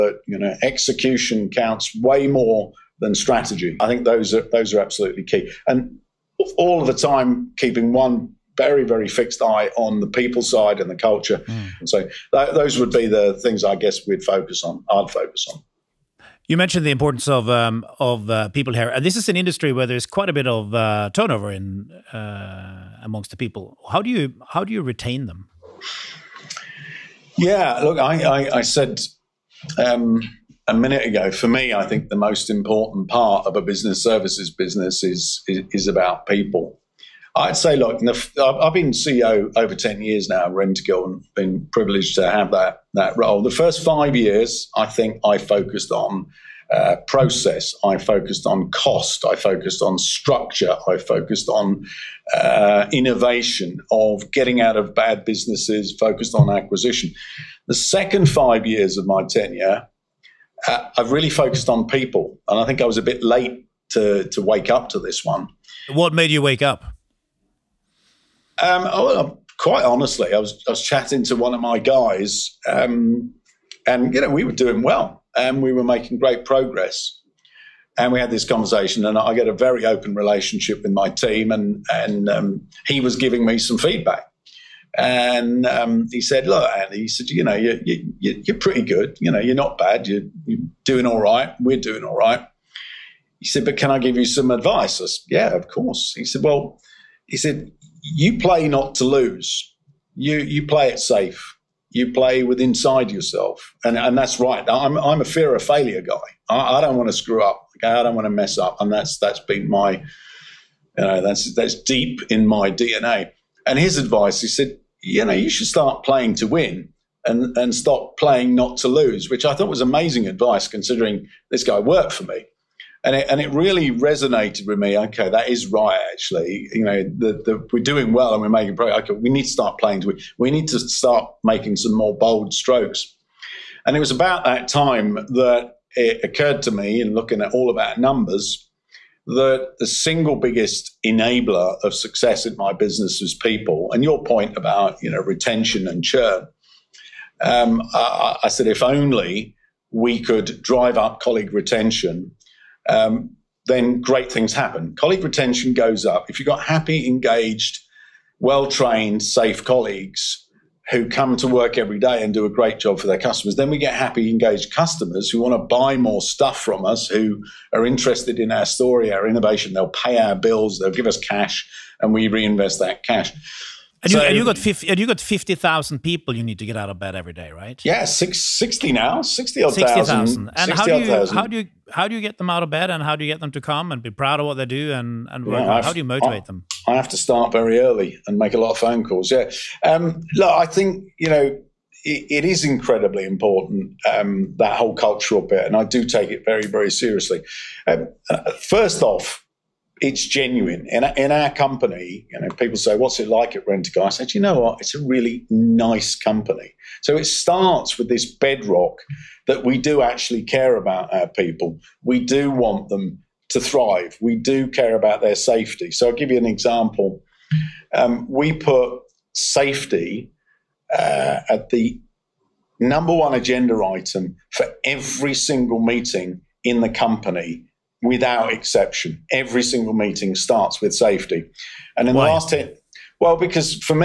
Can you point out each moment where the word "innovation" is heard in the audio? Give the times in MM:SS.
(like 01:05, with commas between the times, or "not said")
00:52, 02:49.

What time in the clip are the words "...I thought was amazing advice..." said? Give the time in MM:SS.
01:59.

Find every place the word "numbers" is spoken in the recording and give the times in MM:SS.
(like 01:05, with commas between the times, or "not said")
02:17, 03:42.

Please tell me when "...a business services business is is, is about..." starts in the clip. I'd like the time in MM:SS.
00:33.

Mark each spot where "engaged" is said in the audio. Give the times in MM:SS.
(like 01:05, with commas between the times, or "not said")
02:37, 02:44.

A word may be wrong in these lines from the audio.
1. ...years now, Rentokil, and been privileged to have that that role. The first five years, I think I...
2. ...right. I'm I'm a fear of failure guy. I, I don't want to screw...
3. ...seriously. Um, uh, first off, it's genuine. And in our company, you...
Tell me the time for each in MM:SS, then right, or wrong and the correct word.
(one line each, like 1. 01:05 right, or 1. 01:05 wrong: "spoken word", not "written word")
1. 00:40 right
2. 01:44 right
3. 03:16 right.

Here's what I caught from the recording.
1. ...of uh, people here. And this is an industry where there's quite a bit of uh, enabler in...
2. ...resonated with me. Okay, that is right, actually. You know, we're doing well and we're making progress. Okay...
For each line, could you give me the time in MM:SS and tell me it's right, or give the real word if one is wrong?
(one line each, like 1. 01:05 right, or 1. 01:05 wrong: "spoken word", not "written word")
1. 00:17 wrong: "turnover", not "enabler"
2. 02:03 right.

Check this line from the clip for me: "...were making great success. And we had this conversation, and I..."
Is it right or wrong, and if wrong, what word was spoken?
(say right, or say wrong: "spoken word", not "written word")
wrong: "progress", not "success".